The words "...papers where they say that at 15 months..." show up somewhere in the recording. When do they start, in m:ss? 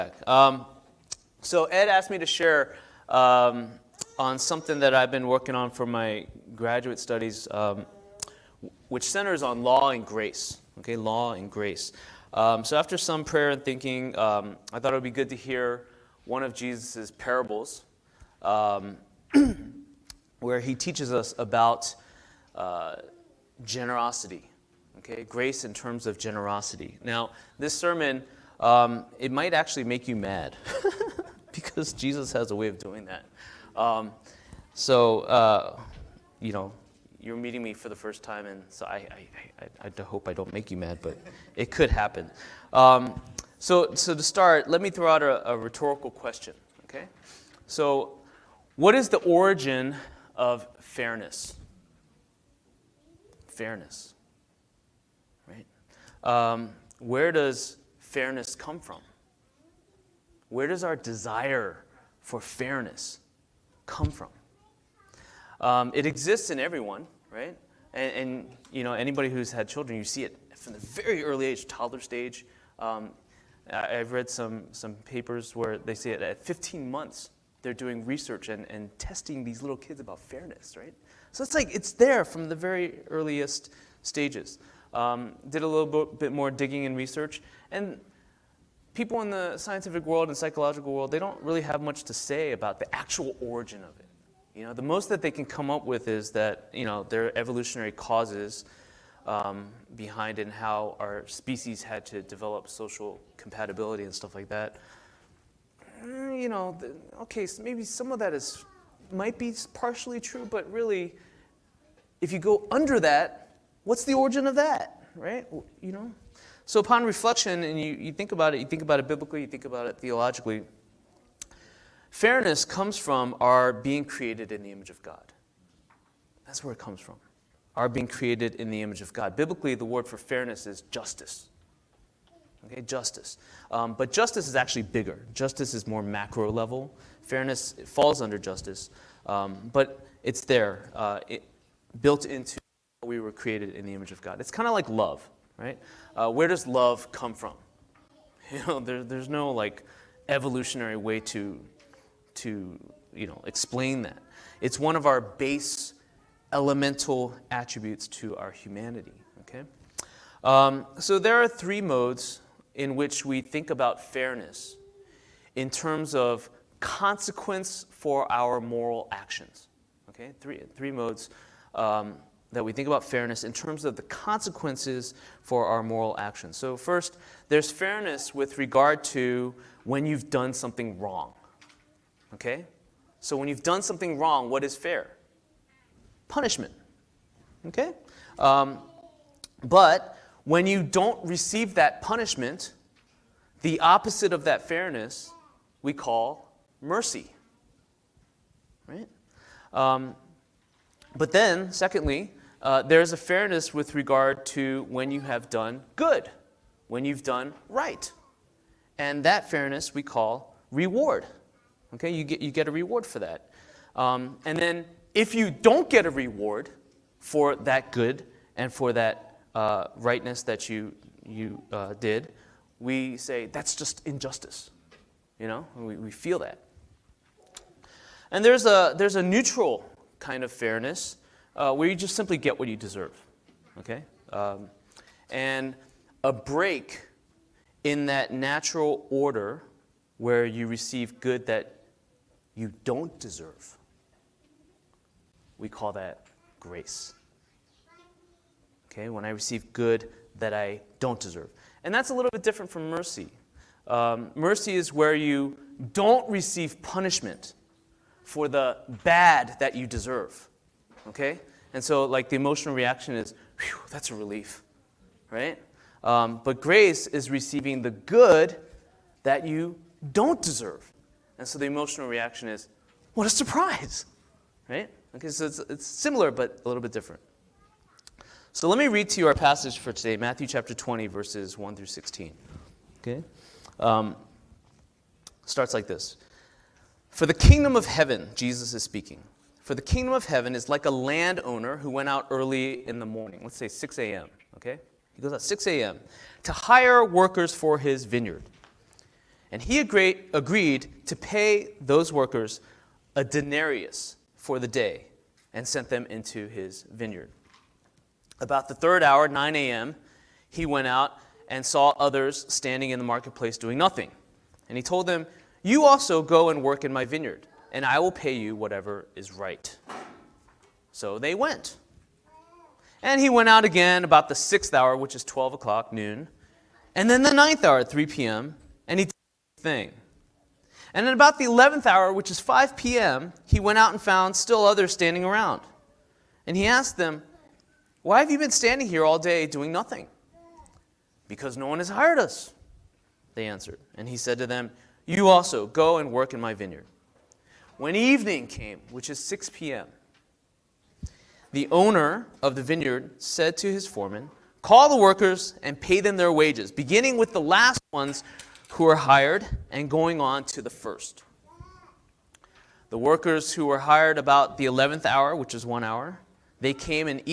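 1:14.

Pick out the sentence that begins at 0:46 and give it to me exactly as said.
Okay, so what is the origin of fairness?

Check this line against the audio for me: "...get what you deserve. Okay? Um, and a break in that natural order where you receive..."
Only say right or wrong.
right.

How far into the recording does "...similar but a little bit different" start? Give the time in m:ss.
4:35.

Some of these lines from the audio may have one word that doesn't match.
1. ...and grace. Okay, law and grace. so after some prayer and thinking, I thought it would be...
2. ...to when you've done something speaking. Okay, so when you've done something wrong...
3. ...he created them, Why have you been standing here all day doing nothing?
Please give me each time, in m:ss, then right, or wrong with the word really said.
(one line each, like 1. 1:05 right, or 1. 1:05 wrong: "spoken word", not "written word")
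1. 0:09 right
2. 2:59 wrong: "wrong", not "speaking"
3. 5:36 wrong: "asked", not "created".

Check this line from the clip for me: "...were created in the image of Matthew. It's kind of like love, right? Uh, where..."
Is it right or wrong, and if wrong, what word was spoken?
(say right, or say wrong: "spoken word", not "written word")
wrong: "God", not "Matthew".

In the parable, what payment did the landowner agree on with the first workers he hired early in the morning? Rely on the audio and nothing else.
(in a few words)
A denarius.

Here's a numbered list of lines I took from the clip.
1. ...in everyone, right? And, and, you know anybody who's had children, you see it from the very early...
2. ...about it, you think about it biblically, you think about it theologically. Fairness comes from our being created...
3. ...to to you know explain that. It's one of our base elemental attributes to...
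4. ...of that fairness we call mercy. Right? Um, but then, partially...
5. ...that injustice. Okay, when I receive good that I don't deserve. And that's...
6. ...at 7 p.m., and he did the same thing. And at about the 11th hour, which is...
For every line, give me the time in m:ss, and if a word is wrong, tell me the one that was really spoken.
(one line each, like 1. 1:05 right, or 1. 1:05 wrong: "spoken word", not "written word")
1. 1:06 right
2. 1:58 right
3. 2:31 right
4. 3:14 wrong: "secondly", not "partially"
5. 4:05 wrong: "grace", not "injustice"
6. 5:27 wrong: "3", not "7".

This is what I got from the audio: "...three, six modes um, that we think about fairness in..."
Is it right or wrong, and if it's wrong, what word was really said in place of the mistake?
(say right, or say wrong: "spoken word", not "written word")
wrong: "three", not "six".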